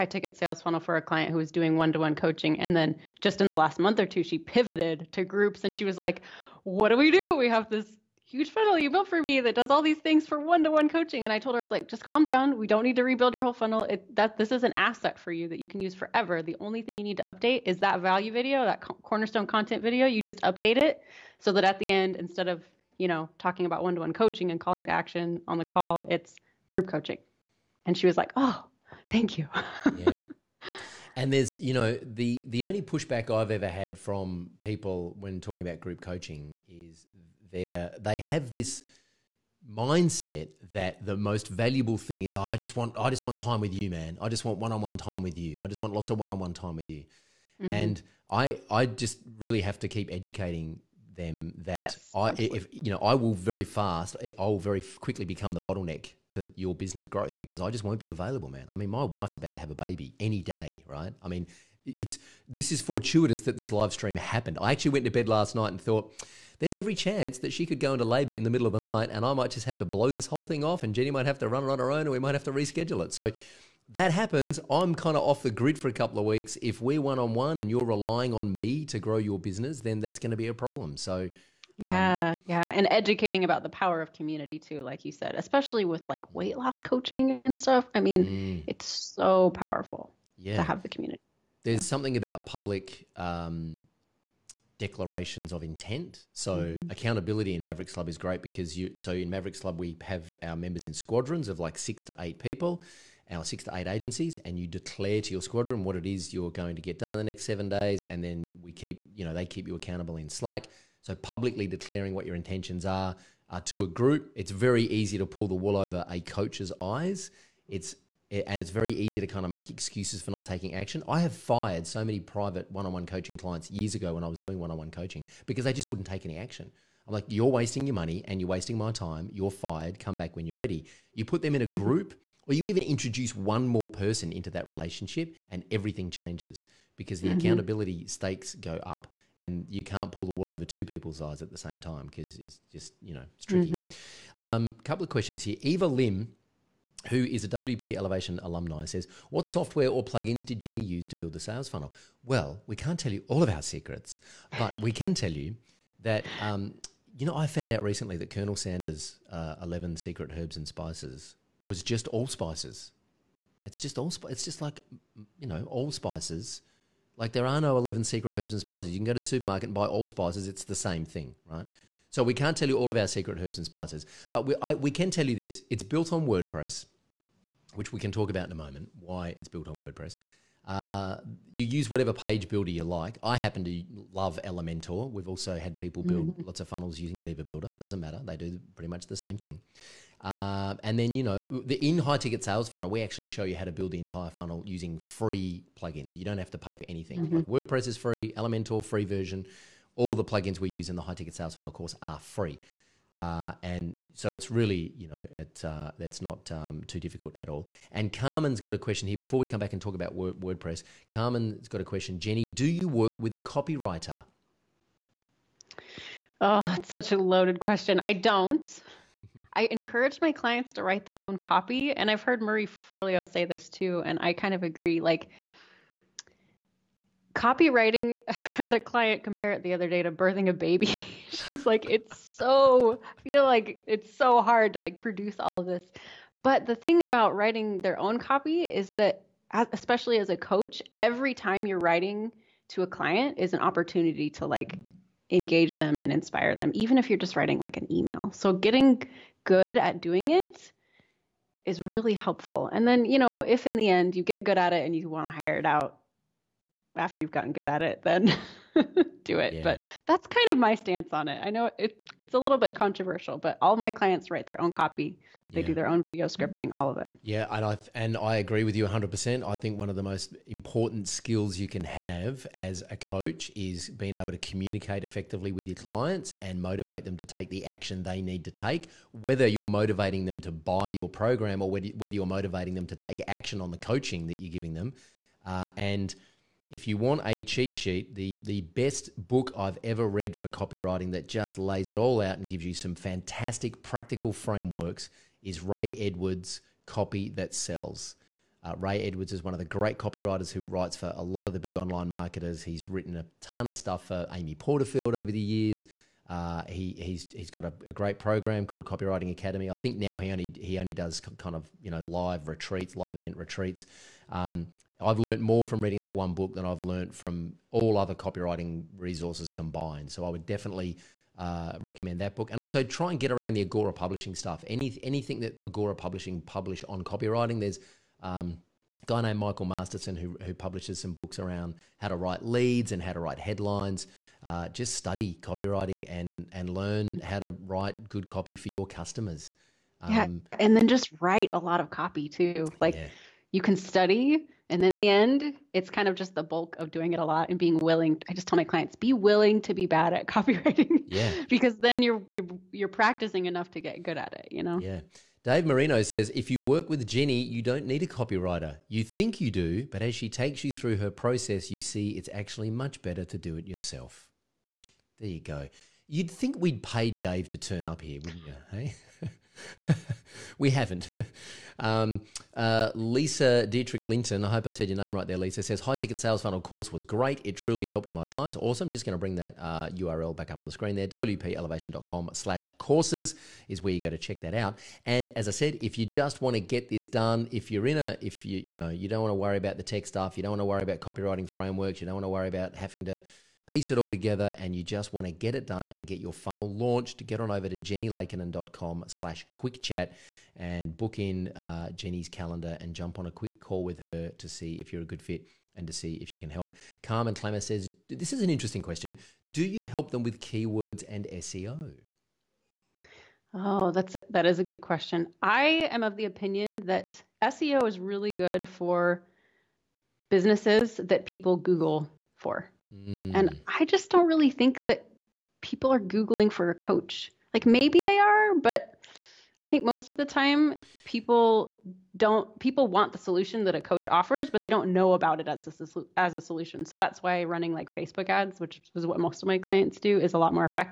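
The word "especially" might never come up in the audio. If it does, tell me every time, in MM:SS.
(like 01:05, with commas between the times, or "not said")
01:25, 03:59.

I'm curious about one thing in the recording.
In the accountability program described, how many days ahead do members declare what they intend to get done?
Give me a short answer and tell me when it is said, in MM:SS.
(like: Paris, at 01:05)
7, at 01:47.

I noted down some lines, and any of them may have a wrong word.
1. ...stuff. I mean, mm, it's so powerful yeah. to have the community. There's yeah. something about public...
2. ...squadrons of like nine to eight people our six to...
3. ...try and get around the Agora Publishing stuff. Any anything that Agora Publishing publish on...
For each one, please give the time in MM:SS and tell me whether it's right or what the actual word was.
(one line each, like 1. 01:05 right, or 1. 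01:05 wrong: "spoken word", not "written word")
1. 01:27 right
2. 01:40 wrong: "six", not "nine"
3. 05:22 right.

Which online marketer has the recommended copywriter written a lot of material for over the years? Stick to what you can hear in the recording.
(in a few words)
Amy Porterfield.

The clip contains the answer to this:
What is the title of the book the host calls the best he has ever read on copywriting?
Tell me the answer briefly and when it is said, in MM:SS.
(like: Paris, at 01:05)
Copy That Sells, at 04:56.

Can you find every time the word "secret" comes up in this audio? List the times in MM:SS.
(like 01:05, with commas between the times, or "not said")
02:33, 02:39, 02:48, 02:53.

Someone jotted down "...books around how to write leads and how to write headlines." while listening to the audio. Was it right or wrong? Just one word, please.
right.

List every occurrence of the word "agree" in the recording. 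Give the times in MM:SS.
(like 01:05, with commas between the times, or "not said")
03:44, 04:28.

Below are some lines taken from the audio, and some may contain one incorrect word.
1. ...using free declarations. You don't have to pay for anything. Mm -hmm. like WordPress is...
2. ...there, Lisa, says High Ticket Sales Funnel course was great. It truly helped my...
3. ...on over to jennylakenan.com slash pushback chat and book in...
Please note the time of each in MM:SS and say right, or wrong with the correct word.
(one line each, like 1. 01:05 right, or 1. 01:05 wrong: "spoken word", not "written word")
1. 03:14 wrong: "plugins", not "declarations"
2. 06:15 right
3. 06:37 wrong: "quick", not "pushback".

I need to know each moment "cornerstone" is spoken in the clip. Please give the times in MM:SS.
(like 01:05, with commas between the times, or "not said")
00:19.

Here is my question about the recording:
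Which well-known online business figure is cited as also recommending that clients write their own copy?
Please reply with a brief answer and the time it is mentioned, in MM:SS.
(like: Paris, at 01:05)
Marie Forleo, at 03:42.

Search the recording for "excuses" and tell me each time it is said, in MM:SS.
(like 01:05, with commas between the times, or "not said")
01:59.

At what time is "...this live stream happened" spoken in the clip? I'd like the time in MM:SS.
01:03.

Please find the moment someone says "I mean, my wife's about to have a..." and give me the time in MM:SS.
00:58.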